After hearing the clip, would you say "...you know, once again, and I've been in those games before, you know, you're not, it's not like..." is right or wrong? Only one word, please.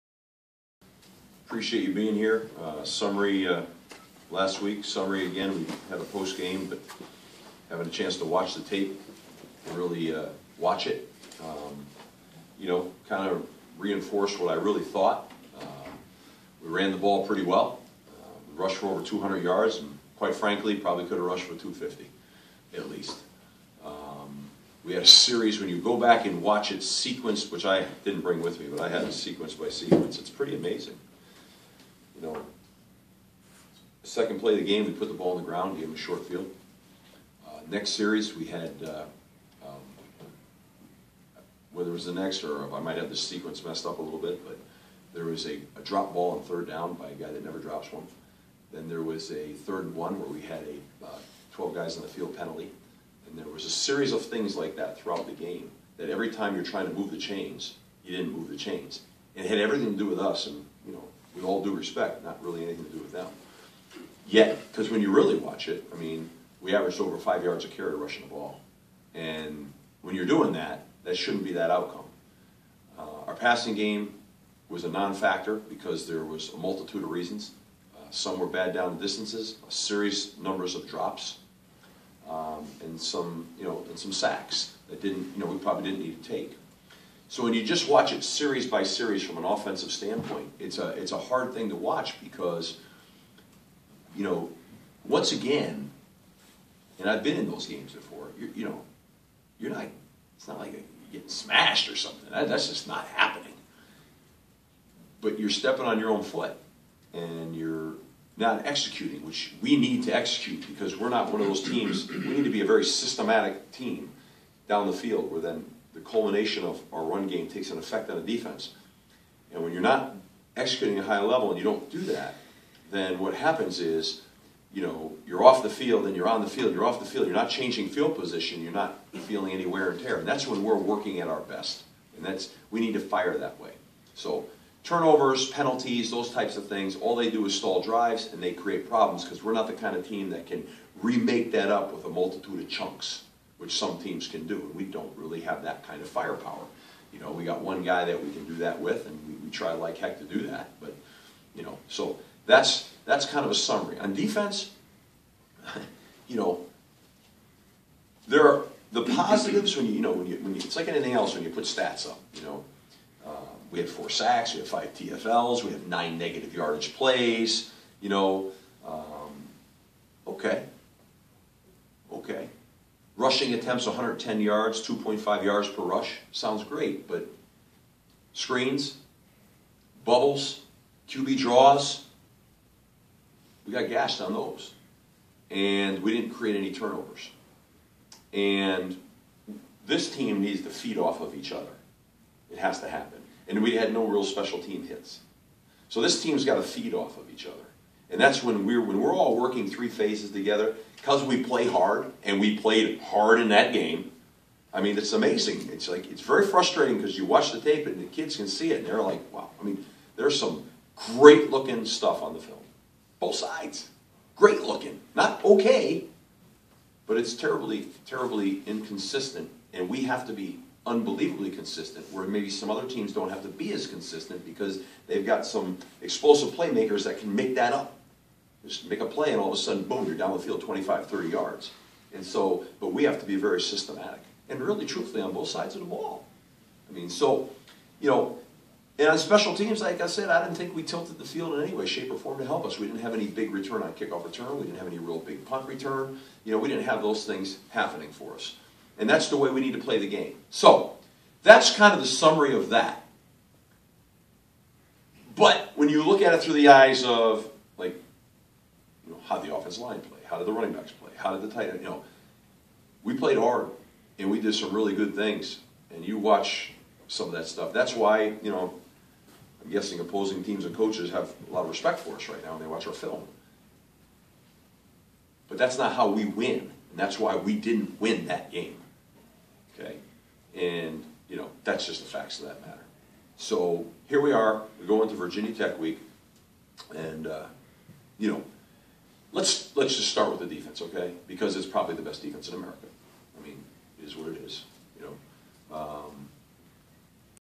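right.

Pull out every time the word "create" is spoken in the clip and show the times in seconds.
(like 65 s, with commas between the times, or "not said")
138 s, 186 s.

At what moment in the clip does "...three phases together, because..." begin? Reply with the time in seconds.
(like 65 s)
199 s.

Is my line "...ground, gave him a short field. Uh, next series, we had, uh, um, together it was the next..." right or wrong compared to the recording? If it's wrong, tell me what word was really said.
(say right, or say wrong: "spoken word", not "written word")
wrong: "whether", not "together".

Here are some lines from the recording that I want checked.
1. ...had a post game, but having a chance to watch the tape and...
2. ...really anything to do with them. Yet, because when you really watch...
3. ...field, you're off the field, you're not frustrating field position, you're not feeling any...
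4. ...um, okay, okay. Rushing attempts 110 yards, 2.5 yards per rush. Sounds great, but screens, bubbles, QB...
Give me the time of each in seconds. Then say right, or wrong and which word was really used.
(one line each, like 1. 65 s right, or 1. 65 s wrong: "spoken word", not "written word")
1. 5 s right
2. 62 s right
3. 126 s wrong: "changing", not "frustrating"
4. 168 s right.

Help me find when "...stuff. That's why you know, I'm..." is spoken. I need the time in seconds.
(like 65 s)
267 s.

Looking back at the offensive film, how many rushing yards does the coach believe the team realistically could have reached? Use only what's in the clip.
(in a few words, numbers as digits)
250.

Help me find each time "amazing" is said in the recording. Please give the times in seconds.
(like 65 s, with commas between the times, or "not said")
30 s, 205 s.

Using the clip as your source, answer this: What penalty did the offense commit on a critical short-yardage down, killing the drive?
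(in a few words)
12 men on the field.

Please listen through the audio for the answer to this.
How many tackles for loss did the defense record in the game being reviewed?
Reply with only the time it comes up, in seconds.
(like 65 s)
164 s.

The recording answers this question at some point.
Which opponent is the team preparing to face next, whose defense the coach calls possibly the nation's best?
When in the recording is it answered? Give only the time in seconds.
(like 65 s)
285 s.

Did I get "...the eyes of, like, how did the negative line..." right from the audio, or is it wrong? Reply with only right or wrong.
wrong.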